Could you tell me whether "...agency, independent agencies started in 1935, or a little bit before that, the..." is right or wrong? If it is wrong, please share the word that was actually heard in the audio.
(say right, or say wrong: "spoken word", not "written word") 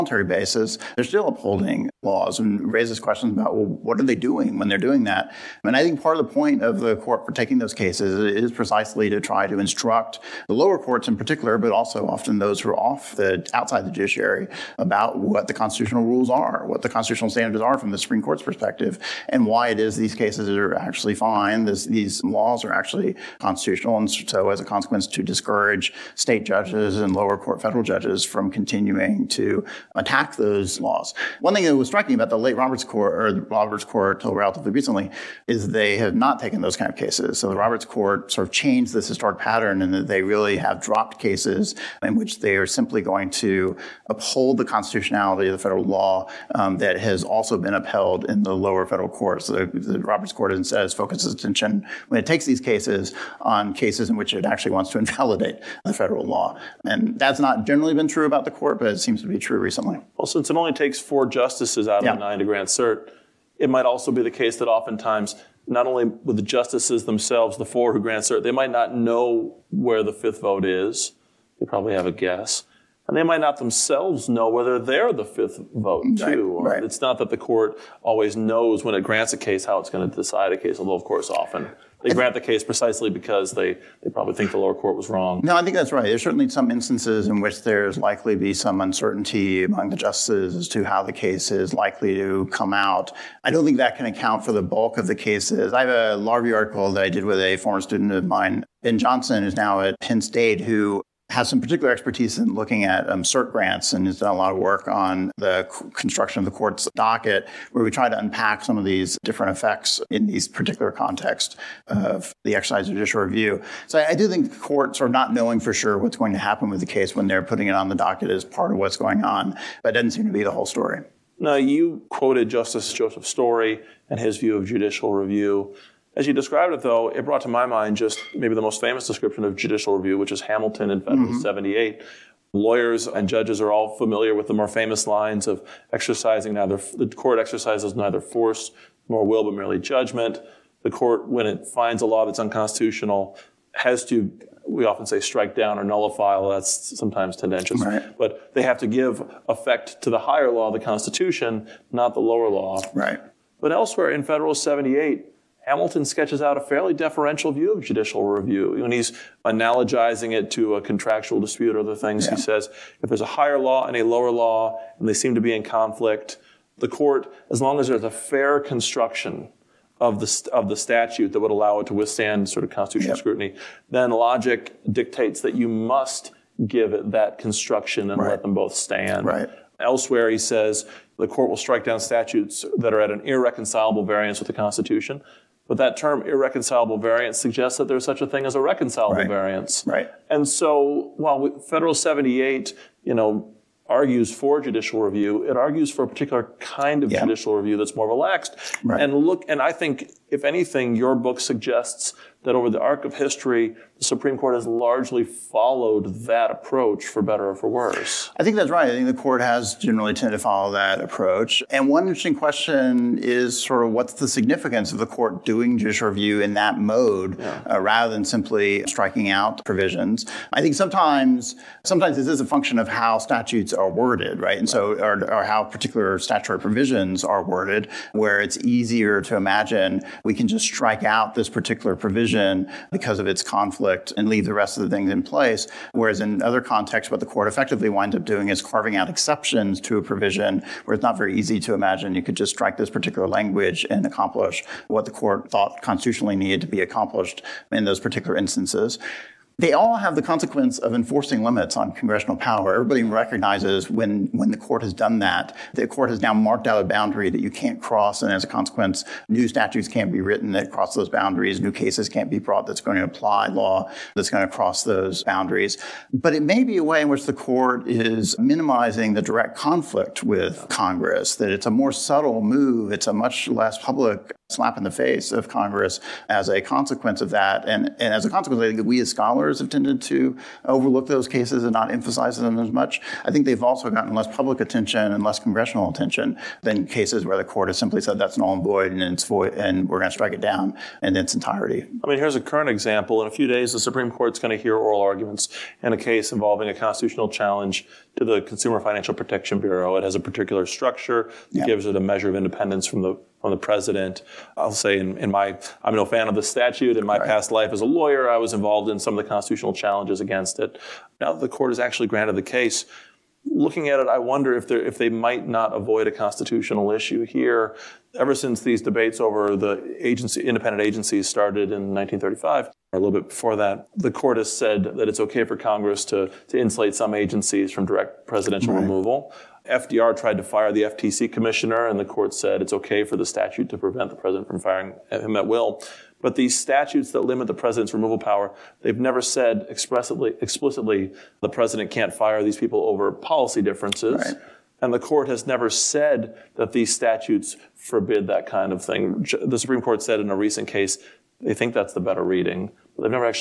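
right.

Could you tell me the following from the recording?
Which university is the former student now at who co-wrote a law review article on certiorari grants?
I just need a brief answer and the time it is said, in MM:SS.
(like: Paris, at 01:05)
Penn State, at 01:39.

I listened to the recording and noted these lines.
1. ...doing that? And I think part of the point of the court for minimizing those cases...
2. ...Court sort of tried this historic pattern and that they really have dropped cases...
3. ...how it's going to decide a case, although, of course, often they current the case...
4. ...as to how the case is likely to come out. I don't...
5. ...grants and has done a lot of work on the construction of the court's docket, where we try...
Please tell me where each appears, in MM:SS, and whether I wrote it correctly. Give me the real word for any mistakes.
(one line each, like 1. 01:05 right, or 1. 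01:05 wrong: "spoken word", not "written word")
1. 00:04 wrong: "taking", not "minimizing"
2. 00:37 wrong: "changed", not "tried"
3. 01:19 wrong: "grant", not "current"
4. 01:30 right
5. 01:43 right.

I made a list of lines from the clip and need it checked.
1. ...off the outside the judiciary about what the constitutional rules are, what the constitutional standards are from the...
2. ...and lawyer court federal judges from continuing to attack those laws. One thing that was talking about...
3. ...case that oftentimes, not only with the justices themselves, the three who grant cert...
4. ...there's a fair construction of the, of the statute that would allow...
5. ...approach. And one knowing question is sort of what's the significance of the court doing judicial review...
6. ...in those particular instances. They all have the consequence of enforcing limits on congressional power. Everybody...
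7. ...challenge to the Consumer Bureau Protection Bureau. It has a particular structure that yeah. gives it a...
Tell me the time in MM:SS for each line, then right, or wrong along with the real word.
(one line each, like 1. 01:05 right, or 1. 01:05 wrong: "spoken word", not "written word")
1. 00:12 right
2. 00:26 wrong: "lower", not "lawyer"
3. 01:04 wrong: "four", not "three"
4. 02:47 right
5. 03:31 wrong: "interesting", not "knowing"
6. 04:07 right
7. 04:57 wrong: "Financial", not "Bureau".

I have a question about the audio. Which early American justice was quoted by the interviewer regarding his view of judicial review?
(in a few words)
Joseph Story.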